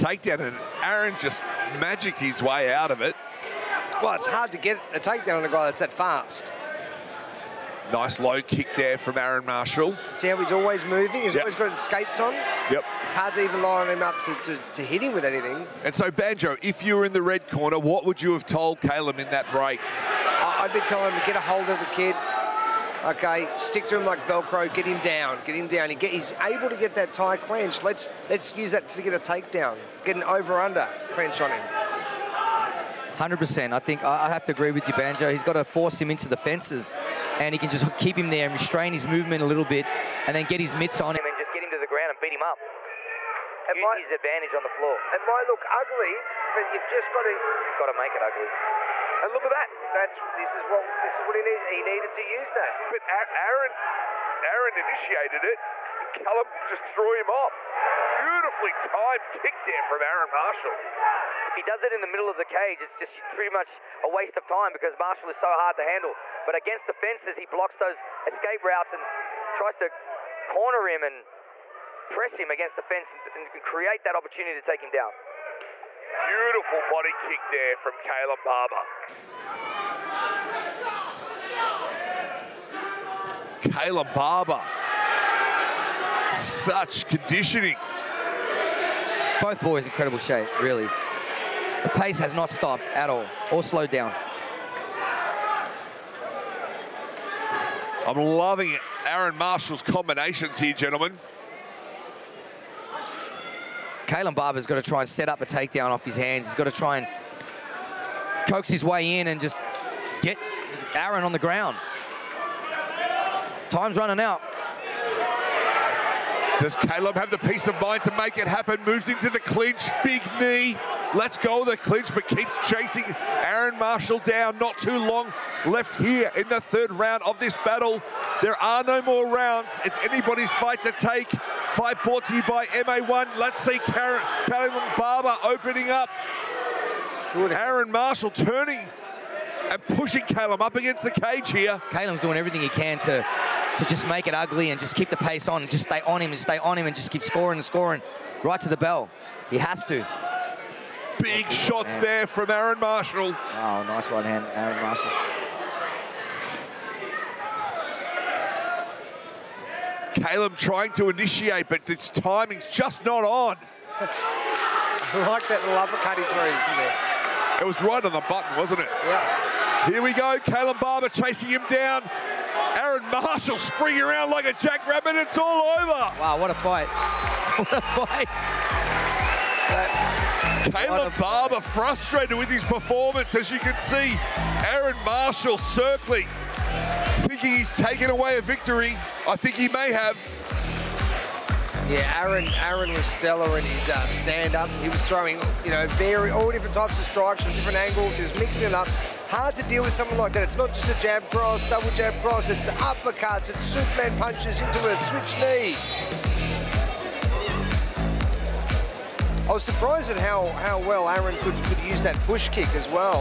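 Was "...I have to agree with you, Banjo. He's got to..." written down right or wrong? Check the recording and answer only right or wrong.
right.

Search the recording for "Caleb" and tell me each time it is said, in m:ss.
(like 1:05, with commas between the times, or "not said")
0:18, 1:56, 2:40, 2:50, 3:00.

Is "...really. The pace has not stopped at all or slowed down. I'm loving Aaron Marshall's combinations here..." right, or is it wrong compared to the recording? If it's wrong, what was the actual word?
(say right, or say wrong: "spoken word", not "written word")
right.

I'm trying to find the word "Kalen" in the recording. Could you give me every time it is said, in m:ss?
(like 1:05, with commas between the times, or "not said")
1:17, 1:23, 1:44.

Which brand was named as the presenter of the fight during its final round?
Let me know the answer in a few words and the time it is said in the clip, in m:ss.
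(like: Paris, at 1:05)
MA1, at 2:12.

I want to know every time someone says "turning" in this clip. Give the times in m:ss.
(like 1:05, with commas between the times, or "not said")
2:18.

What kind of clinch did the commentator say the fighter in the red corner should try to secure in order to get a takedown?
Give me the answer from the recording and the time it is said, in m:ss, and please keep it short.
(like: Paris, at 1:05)
Over-under, at 0:30.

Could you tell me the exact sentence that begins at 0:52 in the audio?
But Aaron, Aaron initiated it and Callum just threw him off.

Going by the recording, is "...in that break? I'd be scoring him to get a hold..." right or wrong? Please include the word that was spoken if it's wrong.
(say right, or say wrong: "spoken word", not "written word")
wrong: "telling", not "scoring".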